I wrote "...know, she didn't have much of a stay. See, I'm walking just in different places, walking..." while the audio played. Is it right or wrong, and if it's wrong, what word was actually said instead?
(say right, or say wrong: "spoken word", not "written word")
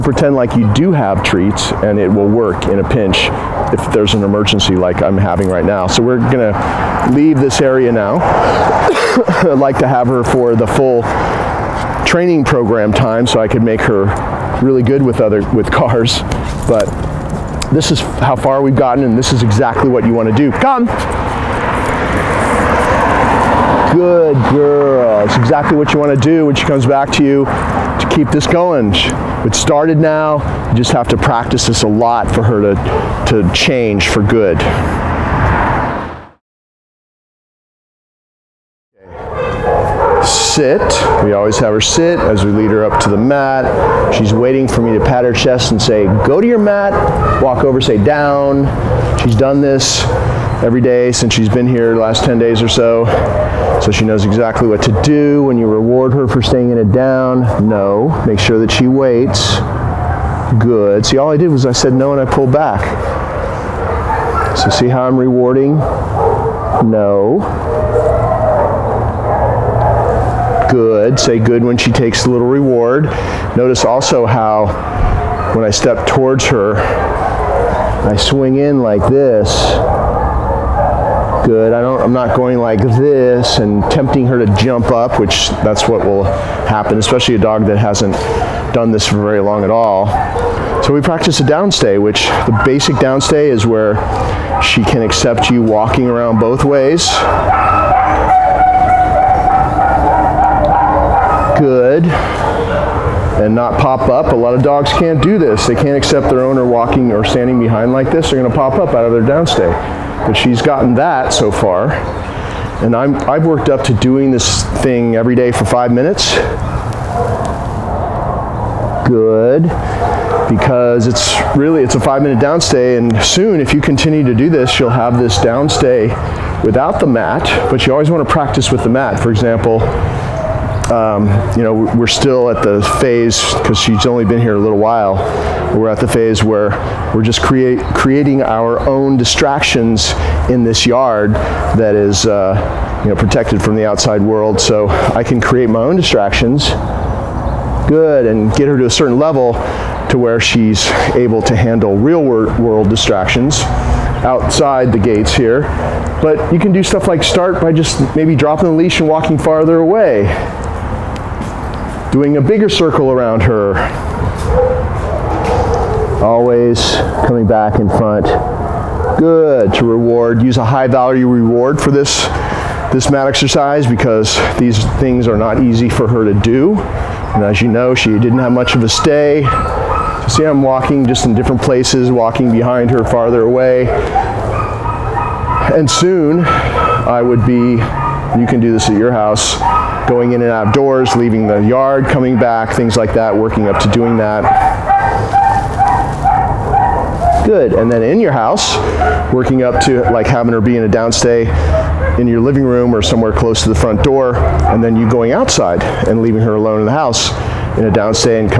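right.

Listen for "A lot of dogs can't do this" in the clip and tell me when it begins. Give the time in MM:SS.
01:44.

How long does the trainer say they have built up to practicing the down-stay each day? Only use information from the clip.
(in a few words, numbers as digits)
5 minutes.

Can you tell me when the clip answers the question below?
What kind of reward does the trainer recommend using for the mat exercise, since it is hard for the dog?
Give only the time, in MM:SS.
02:50.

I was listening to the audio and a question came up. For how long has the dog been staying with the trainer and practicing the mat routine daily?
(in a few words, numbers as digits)
10 days.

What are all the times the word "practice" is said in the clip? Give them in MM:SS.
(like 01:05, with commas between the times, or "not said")
00:31, 01:31, 02:08.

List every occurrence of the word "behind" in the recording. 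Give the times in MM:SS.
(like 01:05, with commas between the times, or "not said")
01:47, 03:02.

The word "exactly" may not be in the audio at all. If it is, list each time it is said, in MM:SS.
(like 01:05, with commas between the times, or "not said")
00:19, 00:25, 00:54.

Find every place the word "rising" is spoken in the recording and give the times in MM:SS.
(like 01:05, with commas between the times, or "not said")
not said.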